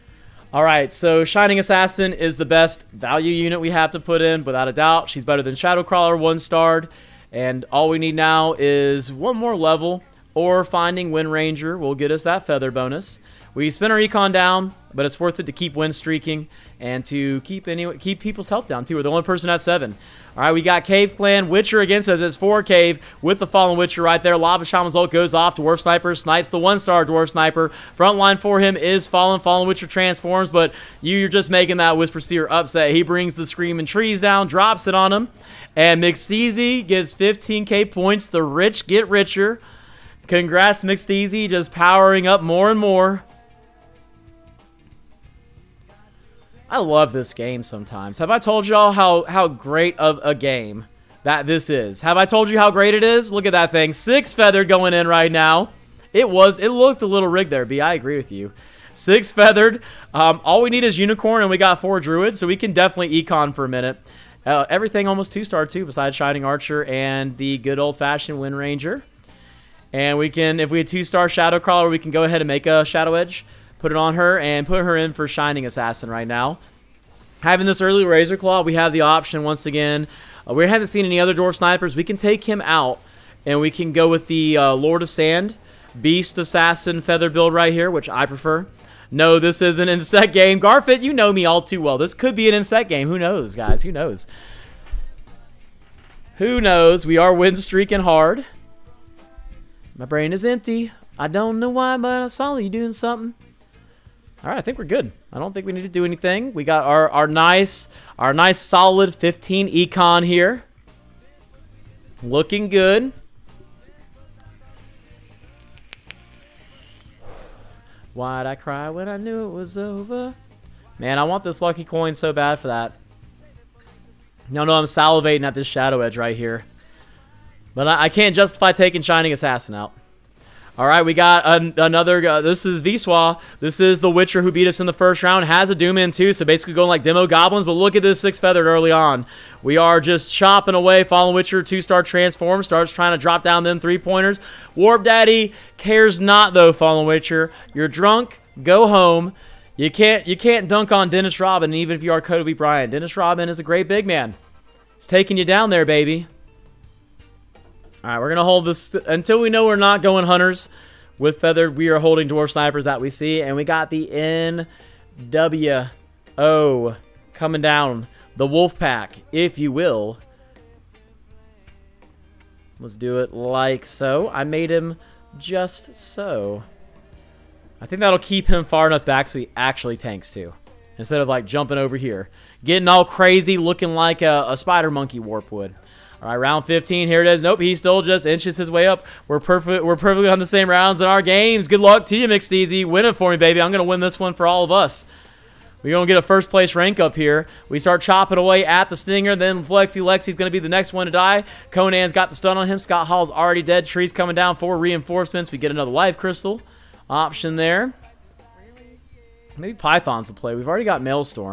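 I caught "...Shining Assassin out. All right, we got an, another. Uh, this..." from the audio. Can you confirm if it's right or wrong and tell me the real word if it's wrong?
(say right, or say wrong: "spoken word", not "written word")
right.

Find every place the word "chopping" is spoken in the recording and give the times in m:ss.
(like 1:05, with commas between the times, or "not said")
2:20, 3:18.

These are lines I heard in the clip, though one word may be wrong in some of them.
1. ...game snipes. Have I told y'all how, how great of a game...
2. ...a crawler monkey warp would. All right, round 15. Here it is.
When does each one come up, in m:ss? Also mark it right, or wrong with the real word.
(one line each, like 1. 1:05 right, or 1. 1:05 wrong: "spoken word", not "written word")
1. 0:47 wrong: "sometimes", not "snipes"
2. 3:04 wrong: "spider", not "crawler".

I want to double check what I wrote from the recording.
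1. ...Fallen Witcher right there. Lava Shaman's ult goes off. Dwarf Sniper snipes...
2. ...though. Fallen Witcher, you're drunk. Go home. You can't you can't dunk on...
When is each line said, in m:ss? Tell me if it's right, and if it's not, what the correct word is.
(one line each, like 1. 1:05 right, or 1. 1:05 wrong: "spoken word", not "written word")
1. 0:23 right
2. 2:26 right.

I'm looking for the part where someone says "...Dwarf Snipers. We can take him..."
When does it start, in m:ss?
1:21.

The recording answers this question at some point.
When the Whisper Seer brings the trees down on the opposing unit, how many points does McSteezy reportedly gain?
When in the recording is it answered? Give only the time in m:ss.
0:37.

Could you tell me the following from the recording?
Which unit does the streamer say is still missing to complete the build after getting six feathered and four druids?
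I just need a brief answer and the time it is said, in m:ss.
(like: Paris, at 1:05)
unicorn, at 1:00.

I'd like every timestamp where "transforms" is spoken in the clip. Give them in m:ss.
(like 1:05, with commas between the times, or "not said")
0:29, 2:22.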